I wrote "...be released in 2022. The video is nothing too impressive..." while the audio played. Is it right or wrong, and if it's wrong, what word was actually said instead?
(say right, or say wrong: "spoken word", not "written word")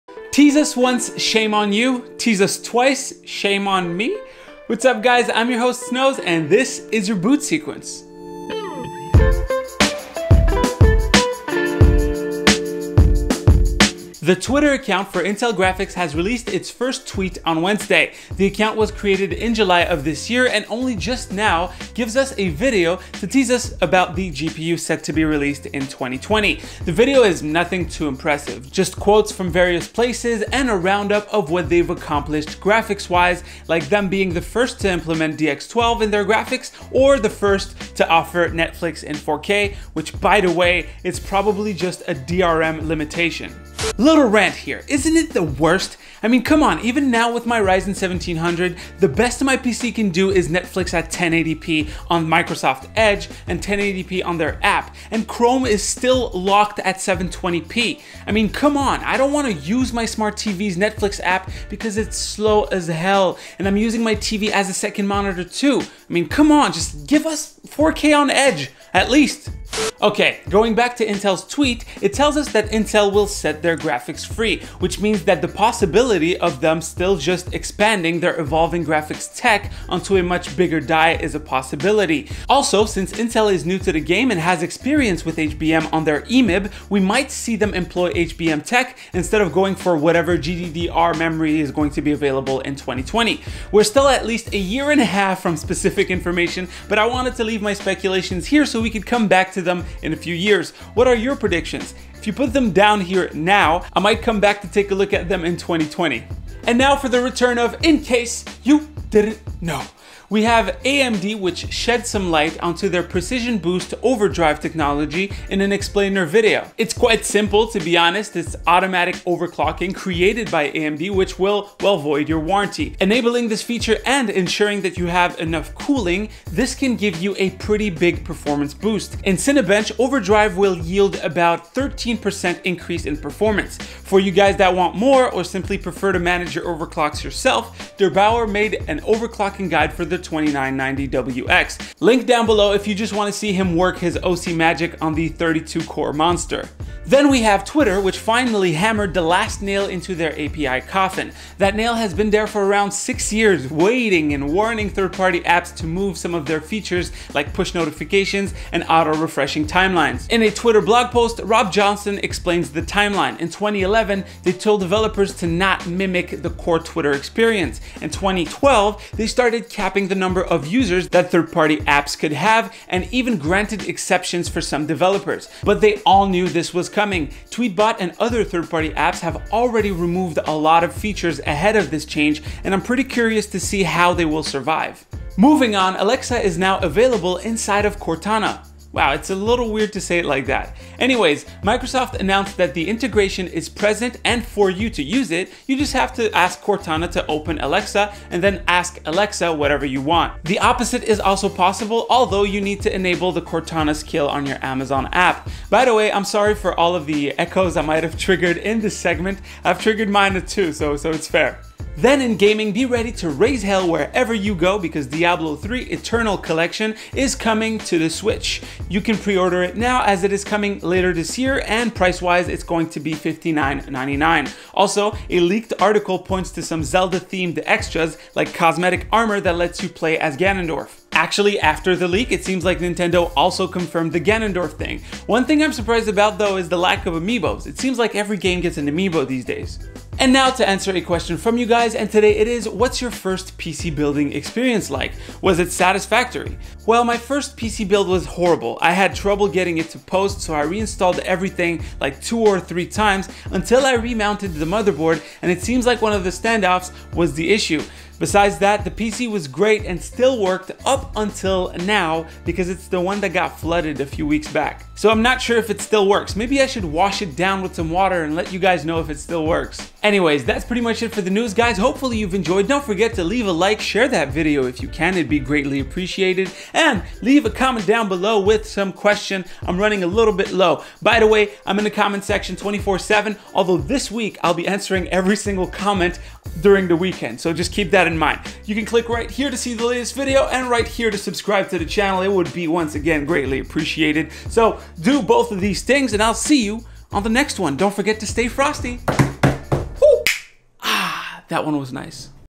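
wrong: "2020", not "2022".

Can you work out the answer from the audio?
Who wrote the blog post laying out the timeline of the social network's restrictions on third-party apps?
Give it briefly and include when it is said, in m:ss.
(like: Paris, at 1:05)
Rob Johnson, at 2:41.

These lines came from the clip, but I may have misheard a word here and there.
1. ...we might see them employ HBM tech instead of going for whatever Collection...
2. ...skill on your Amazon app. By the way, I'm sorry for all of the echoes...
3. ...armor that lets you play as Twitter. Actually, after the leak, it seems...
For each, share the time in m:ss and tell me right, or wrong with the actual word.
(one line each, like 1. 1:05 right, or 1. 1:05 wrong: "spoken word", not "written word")
1. 1:26 wrong: "GDDR", not "Collection"
2. 3:23 right
3. 3:49 wrong: "Ganondorf", not "Twitter".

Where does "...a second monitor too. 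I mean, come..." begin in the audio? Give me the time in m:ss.
1:04.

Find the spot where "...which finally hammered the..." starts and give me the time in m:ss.
2:27.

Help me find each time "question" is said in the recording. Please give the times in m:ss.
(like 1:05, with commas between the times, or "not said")
4:01, 4:38.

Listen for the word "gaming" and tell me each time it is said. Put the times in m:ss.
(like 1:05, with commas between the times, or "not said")
3:32.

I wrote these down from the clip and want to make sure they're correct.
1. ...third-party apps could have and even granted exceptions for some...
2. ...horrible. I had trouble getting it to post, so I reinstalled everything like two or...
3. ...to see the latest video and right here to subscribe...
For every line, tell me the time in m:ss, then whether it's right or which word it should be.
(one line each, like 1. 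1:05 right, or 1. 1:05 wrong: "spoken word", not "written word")
1. 2:51 right
2. 4:08 right
3. 4:49 right.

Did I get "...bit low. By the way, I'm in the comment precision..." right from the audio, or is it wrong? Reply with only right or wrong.
wrong.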